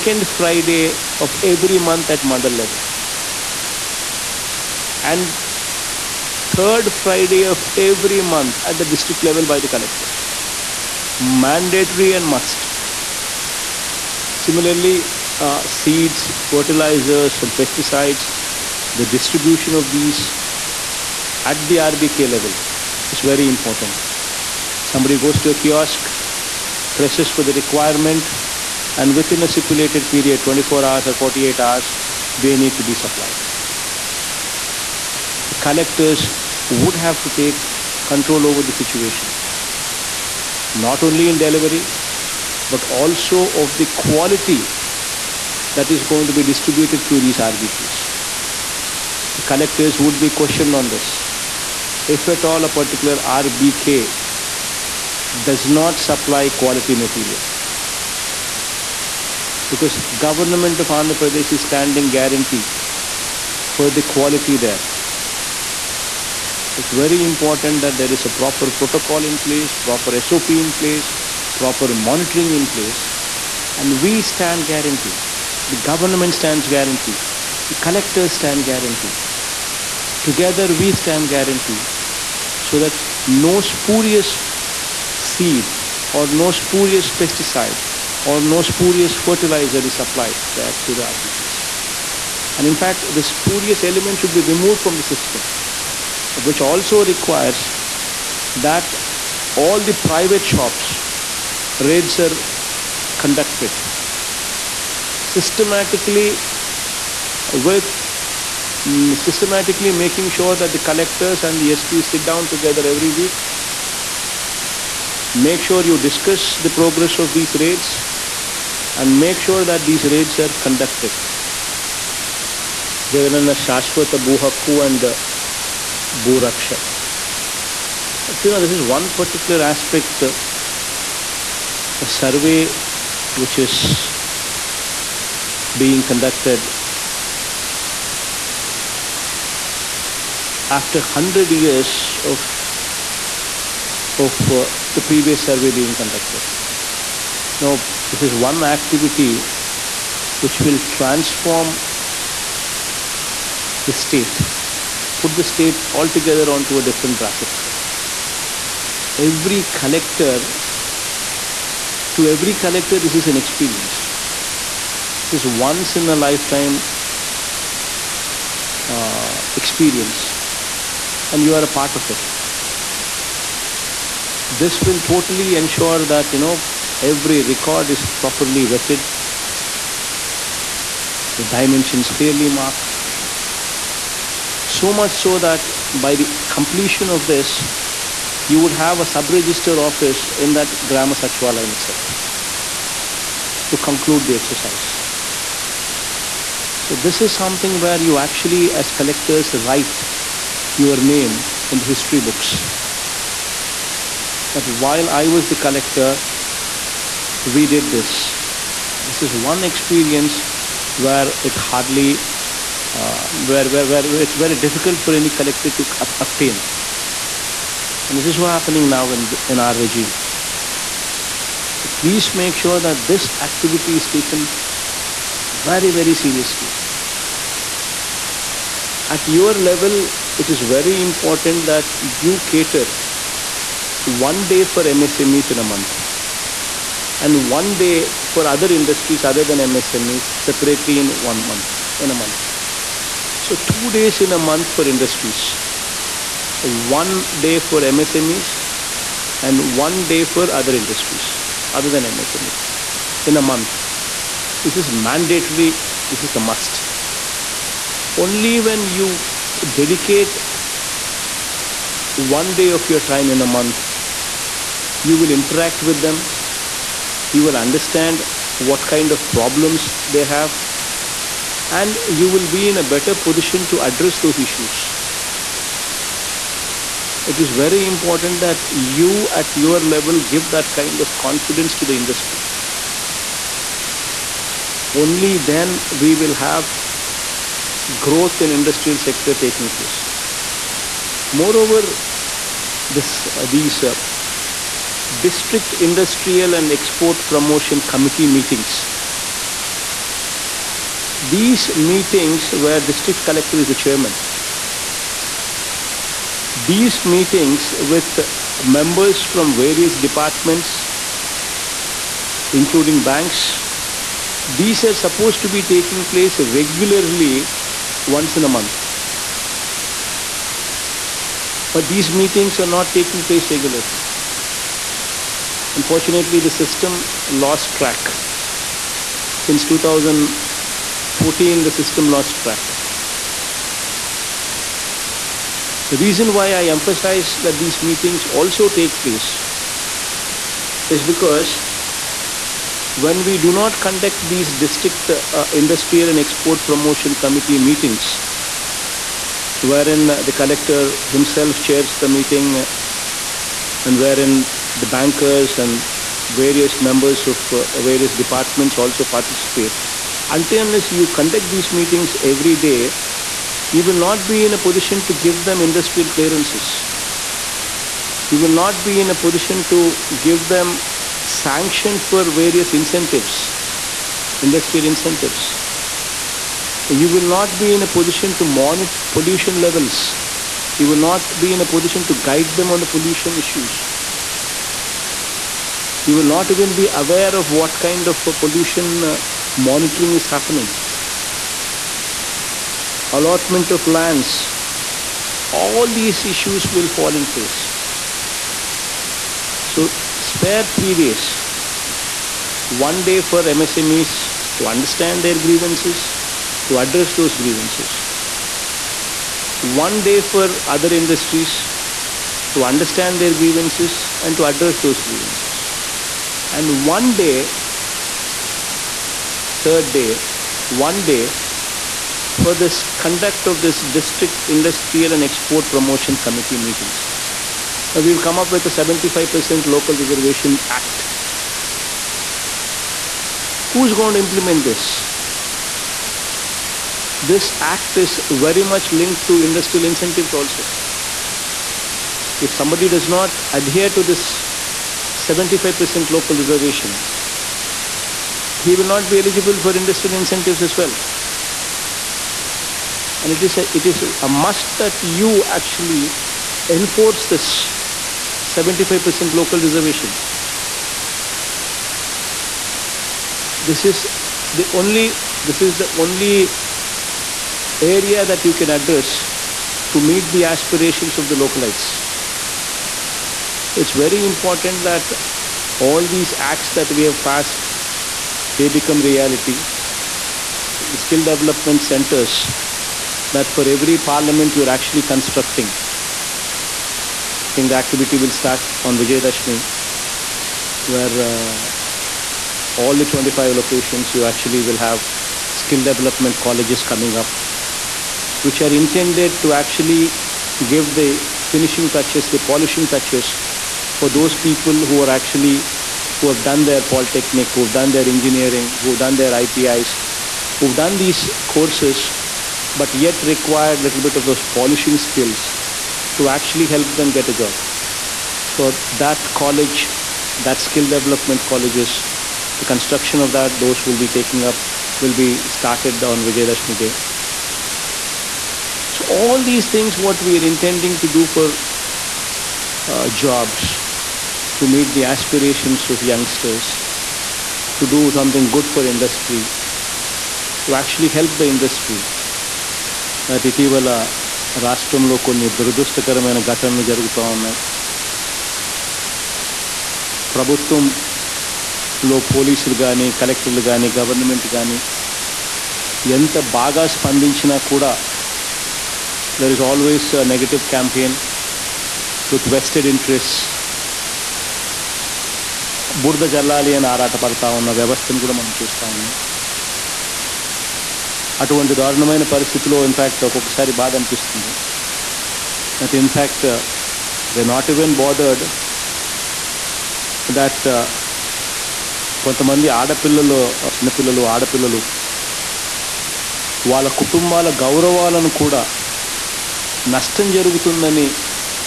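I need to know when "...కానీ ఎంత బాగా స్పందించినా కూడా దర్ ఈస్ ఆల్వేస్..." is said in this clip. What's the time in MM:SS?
09:14.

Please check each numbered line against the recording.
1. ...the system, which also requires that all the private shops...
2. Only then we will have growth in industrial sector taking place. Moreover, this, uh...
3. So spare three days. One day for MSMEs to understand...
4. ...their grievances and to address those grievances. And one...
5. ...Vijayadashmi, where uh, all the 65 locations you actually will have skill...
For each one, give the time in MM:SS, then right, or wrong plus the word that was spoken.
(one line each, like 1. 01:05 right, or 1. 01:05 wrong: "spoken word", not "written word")
1. 01:34 right
2. 04:44 right
3. 06:39 right
4. 06:53 right
5. 08:08 wrong: "25", not "65".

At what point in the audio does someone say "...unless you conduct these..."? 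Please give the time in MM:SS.
06:00.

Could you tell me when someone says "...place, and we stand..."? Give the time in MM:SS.
01:12.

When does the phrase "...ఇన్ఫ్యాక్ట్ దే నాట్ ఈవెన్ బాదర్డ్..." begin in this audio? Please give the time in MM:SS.
09:36.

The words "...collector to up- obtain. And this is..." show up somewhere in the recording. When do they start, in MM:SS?
03:35.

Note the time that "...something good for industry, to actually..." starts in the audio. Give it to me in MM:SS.
08:58.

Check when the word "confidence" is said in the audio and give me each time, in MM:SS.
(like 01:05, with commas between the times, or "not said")
04:41.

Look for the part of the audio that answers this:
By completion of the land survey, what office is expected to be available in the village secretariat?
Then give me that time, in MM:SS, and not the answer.
03:09.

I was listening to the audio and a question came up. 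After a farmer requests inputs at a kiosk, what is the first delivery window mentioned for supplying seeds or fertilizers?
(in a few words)
24 hours.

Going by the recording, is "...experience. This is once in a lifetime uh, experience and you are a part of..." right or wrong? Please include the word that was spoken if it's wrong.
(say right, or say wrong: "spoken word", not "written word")
right.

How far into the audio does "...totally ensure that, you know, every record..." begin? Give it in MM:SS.
02:55.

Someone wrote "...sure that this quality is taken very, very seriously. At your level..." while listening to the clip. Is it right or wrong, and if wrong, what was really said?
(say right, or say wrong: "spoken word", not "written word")
wrong: "activity", not "quality".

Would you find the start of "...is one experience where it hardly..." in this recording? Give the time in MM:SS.
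03:29.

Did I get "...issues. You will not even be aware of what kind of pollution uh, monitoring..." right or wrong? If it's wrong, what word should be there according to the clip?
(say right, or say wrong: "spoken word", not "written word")
right.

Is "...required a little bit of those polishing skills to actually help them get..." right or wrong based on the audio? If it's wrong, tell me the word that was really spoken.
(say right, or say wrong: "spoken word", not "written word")
right.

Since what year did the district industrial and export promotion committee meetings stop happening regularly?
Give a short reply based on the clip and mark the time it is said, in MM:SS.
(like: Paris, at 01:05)
2014, at 05:29.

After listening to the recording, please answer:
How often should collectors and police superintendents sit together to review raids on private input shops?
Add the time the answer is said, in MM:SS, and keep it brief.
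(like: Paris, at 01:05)
Every week, at 01:52.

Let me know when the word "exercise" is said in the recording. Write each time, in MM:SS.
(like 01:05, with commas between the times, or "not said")
03:14.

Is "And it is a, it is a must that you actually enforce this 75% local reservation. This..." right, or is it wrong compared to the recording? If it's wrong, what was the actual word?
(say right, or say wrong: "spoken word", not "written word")
right.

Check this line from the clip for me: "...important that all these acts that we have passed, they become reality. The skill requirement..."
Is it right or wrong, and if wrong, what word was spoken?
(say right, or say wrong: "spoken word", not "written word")
wrong: "development", not "requirement".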